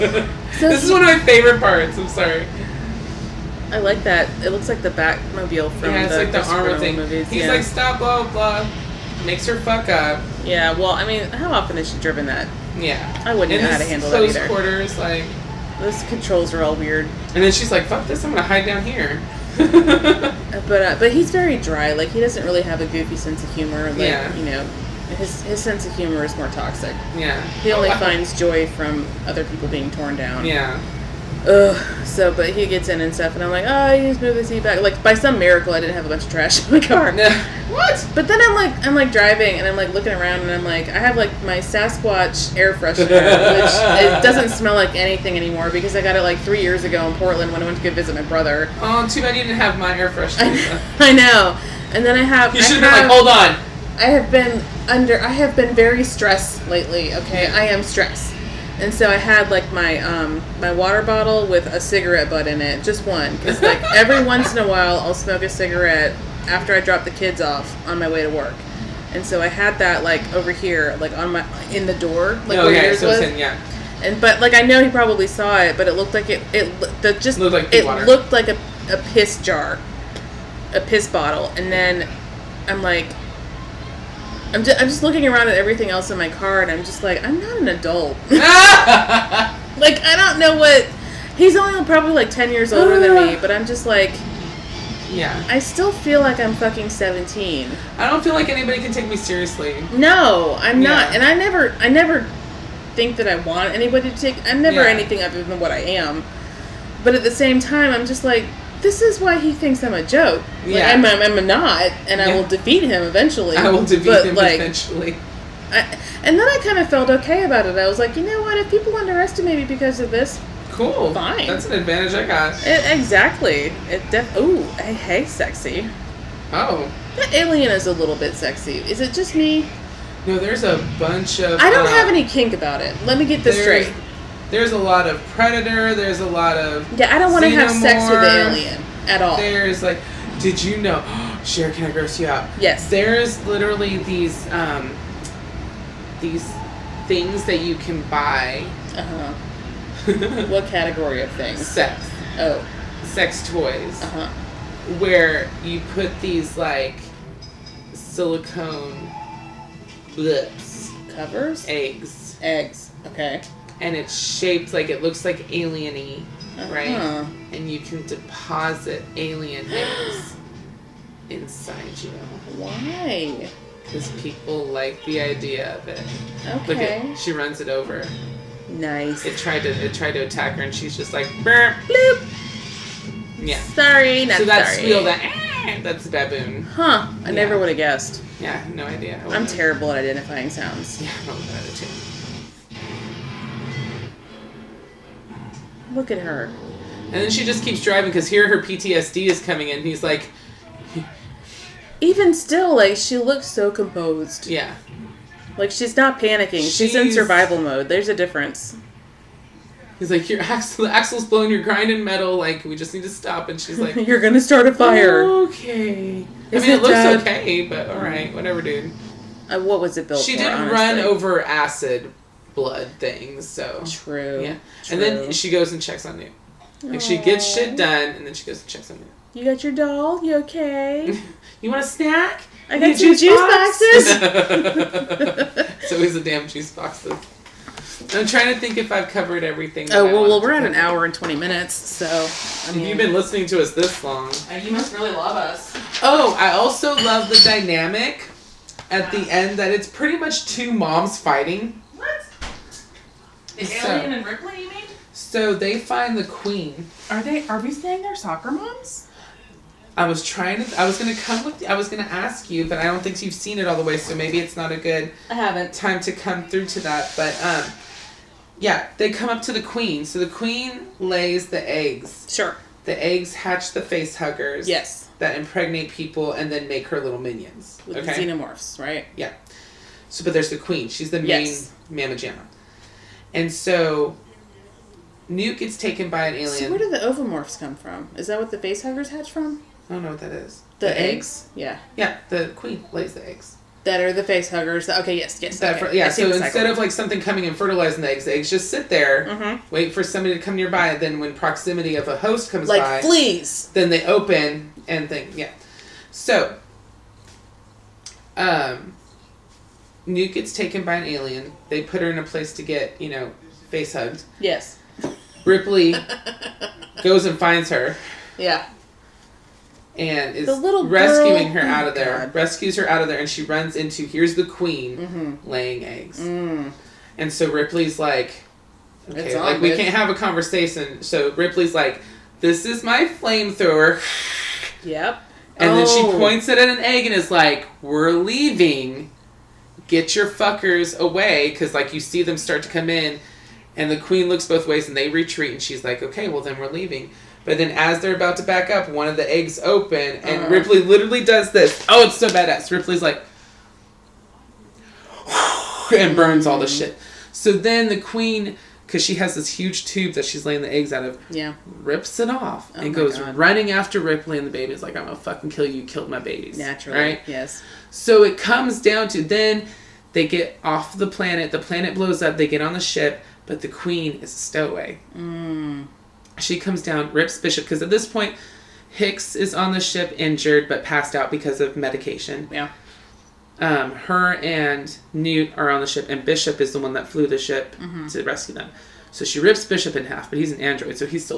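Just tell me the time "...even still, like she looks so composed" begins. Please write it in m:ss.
3:21.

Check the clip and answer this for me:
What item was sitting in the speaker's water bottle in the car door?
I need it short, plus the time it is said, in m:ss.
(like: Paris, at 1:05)
a cigarette butt, at 1:01.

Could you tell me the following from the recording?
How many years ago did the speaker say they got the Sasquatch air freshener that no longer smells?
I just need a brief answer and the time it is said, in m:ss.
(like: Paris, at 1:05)
3, at 0:46.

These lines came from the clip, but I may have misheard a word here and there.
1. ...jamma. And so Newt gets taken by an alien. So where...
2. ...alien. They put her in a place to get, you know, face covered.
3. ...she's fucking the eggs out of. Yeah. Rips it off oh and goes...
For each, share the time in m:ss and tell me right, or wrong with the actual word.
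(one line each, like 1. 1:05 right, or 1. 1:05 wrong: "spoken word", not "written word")
1. 4:42 right
2. 5:11 wrong: "hugged", not "covered"
3. 6:00 wrong: "laying", not "fucking".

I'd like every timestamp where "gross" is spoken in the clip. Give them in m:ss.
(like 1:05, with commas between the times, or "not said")
2:21.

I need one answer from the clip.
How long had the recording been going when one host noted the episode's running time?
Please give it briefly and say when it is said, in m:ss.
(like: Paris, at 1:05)
1 hour 20 minutes, at 4:00.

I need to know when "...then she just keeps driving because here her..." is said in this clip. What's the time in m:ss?
3:17.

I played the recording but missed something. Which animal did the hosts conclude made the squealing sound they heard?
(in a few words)
baboon.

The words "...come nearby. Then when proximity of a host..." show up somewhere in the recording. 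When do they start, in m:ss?
5:00.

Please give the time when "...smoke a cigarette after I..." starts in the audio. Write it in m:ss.
1:05.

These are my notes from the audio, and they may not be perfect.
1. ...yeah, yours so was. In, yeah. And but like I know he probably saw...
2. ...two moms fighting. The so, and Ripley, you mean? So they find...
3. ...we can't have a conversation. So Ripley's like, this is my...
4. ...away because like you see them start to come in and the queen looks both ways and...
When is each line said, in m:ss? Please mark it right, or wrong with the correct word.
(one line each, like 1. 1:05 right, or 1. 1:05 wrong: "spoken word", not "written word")
1. 1:12 right
2. 4:10 right
3. 5:29 right
4. 5:40 right.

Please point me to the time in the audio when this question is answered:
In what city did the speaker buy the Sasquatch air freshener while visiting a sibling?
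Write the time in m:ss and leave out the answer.
0:47.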